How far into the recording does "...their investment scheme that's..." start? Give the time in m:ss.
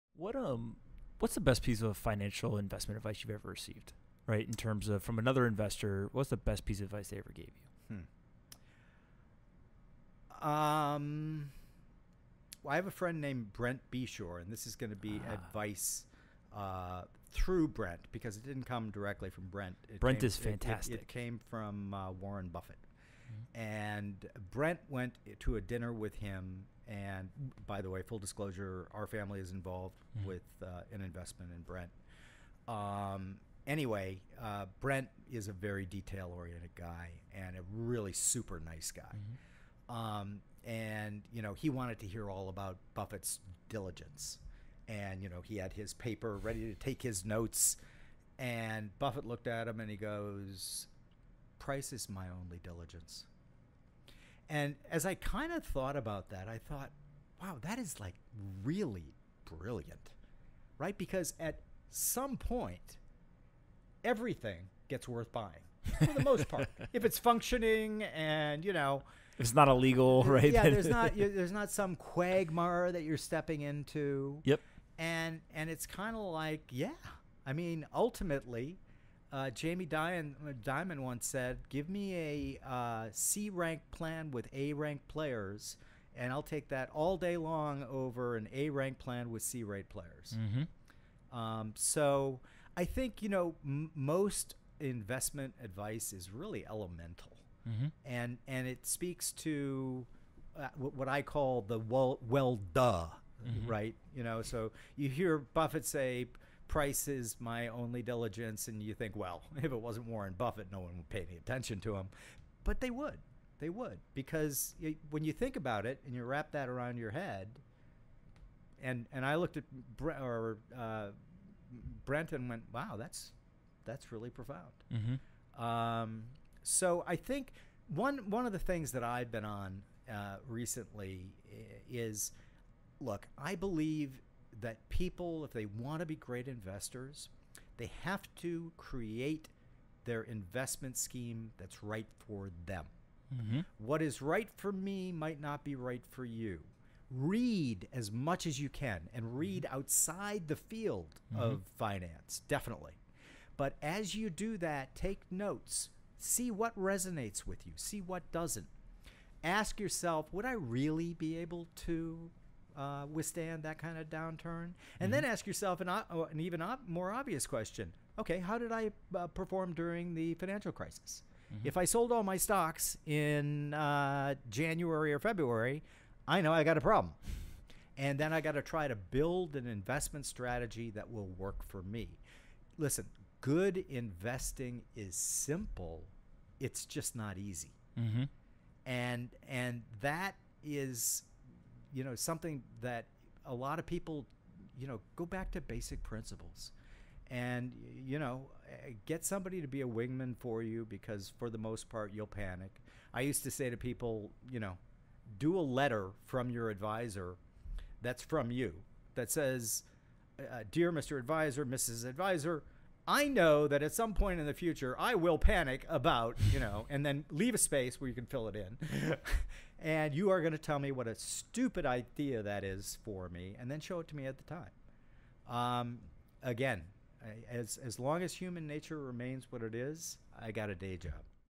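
2:20.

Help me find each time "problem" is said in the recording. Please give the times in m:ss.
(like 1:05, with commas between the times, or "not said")
2:56.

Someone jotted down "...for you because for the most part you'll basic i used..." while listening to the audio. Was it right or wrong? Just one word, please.
wrong.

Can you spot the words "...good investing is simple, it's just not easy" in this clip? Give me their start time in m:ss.
3:03.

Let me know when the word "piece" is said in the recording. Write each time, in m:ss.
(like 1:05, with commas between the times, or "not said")
0:01, 0:06.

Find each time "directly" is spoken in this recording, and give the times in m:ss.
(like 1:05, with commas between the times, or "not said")
0:18.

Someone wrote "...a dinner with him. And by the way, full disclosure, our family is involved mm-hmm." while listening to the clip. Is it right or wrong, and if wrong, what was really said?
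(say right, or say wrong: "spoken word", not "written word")
right.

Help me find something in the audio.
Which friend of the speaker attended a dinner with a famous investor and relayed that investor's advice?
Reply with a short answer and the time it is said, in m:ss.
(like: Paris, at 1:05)
Brent Beshore, at 0:13.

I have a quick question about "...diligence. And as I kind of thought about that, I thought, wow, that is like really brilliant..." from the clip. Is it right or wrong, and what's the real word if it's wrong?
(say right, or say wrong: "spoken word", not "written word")
right.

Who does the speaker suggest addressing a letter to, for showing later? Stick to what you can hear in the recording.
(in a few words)
Your advisor.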